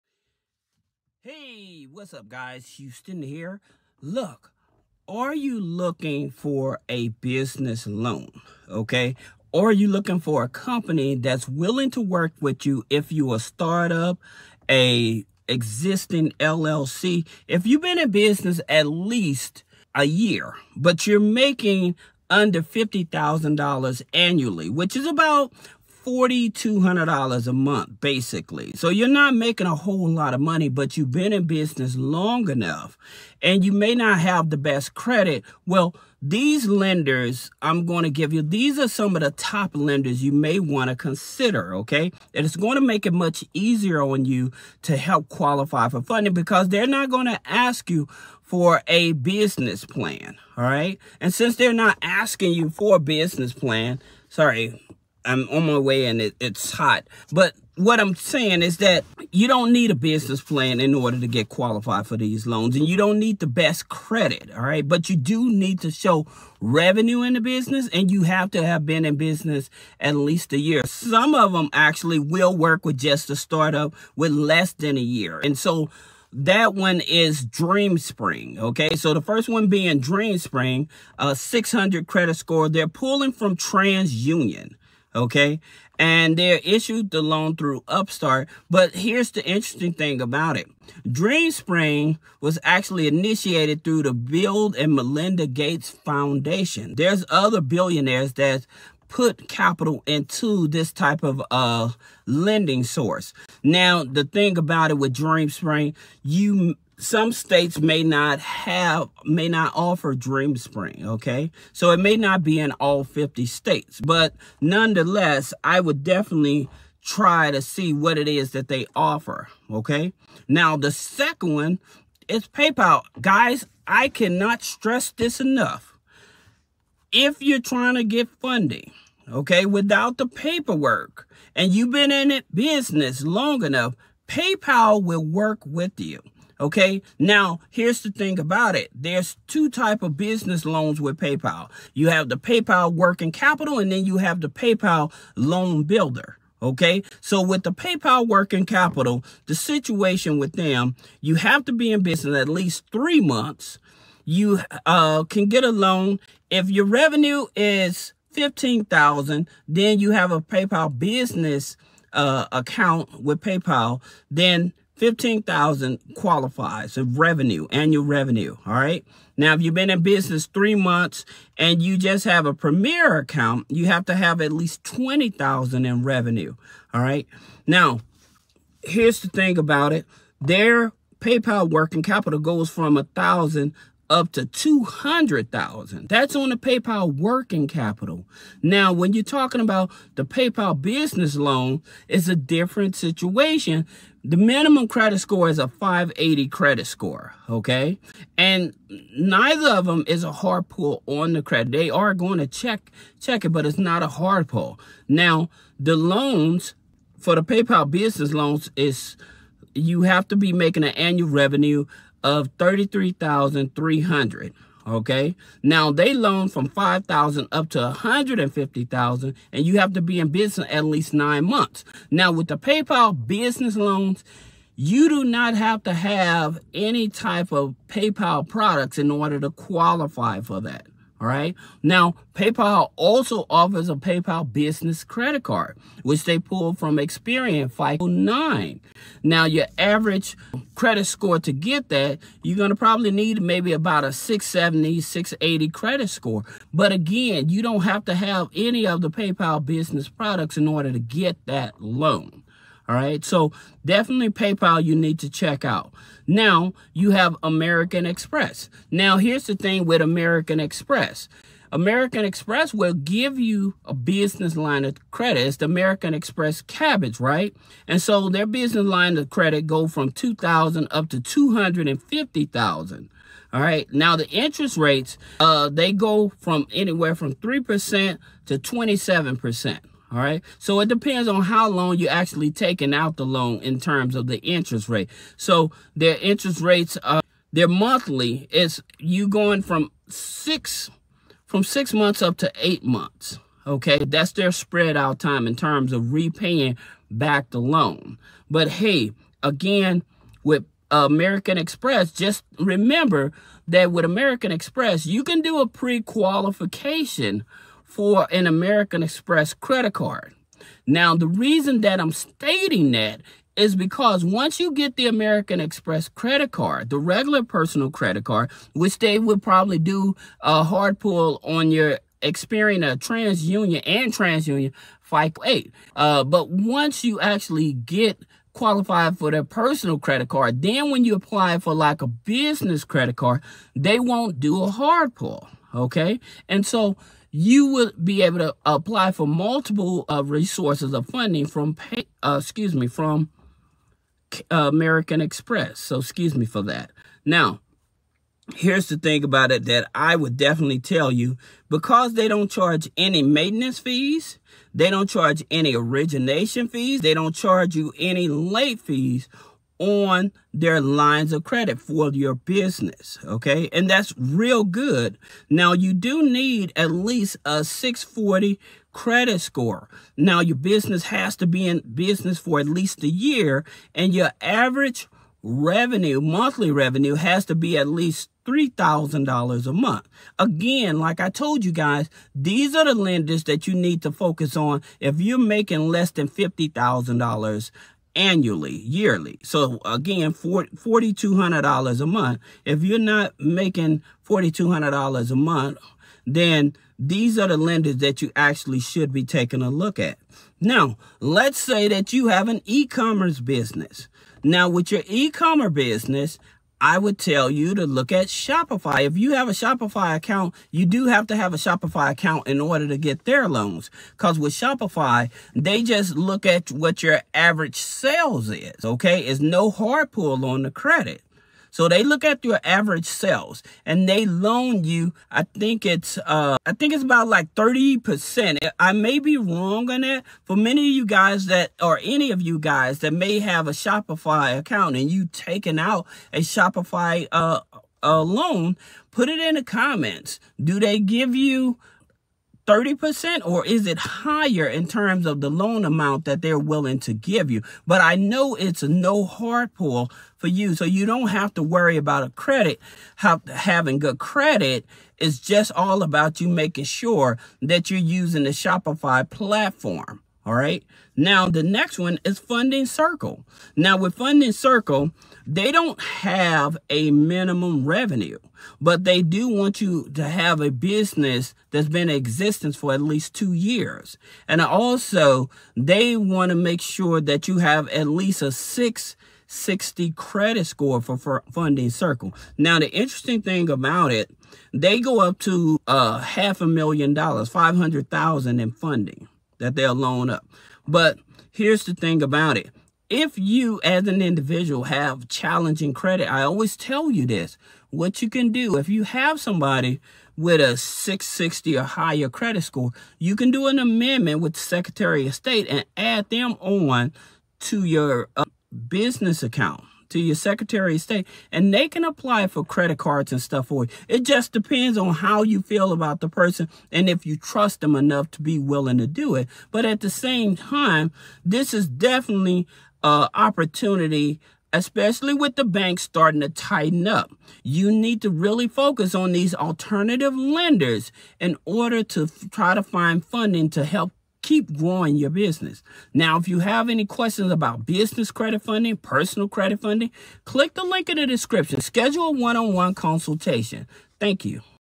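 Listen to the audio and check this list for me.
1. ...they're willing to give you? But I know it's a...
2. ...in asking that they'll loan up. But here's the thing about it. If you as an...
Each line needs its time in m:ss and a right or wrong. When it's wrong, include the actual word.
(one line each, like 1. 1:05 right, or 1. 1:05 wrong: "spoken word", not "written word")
1. 7:26 right
2. 8:08 wrong: "funding", not "asking".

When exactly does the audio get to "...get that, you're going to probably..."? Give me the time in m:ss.
4:01.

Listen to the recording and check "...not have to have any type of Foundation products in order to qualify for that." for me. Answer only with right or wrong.
wrong.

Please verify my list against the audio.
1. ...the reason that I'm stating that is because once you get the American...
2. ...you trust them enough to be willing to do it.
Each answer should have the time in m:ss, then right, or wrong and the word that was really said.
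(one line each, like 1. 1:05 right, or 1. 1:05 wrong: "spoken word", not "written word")
1. 5:11 right
2. 8:37 right.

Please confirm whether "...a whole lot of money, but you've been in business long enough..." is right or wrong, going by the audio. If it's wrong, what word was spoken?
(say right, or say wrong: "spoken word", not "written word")
right.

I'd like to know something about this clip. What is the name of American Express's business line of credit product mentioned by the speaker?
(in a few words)
American Express Kabbage.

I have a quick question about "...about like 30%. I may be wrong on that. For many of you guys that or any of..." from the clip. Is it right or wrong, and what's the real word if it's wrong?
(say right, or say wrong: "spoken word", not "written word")
right.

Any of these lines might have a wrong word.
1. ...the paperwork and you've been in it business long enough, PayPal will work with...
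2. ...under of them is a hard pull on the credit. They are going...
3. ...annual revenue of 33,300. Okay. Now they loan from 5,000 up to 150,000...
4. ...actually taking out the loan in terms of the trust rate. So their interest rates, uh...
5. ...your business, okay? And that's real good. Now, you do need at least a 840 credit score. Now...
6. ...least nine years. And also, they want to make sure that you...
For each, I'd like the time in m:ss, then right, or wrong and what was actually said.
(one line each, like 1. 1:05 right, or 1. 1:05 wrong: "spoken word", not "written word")
1. 2:10 right
2. 3:19 wrong: "neither", not "under"
3. 3:30 right
4. 4:42 wrong: "interest", not "trust"
5. 6:02 wrong: "640", not "840"
6. 7:53 wrong: "two", not "nine".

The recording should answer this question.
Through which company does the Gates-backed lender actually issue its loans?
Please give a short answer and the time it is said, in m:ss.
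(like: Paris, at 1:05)
Upstart, at 1:27.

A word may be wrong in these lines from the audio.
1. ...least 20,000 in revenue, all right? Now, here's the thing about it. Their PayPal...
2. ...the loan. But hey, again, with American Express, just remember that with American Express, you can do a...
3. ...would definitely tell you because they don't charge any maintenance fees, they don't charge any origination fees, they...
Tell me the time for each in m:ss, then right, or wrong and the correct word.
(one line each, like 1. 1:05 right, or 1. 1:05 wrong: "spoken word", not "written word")
1. 2:54 right
2. 4:57 right
3. 5:50 right.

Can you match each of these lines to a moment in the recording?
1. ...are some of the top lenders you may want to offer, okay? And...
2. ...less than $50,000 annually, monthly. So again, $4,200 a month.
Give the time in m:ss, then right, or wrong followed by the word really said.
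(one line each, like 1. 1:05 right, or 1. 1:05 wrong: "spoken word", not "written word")
1. 0:38 wrong: "consider", not "offer"
2. 6:25 wrong: "yearly", not "monthly".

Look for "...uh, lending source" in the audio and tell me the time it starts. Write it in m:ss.
1:41.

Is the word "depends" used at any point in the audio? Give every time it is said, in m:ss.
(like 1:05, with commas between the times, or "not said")
4:40, 8:34.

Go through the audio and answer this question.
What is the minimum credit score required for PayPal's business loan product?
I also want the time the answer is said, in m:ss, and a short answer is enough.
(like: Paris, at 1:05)
580, at 3:15.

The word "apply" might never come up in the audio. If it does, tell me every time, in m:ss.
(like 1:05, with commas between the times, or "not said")
5:31, 5:38, 8:32.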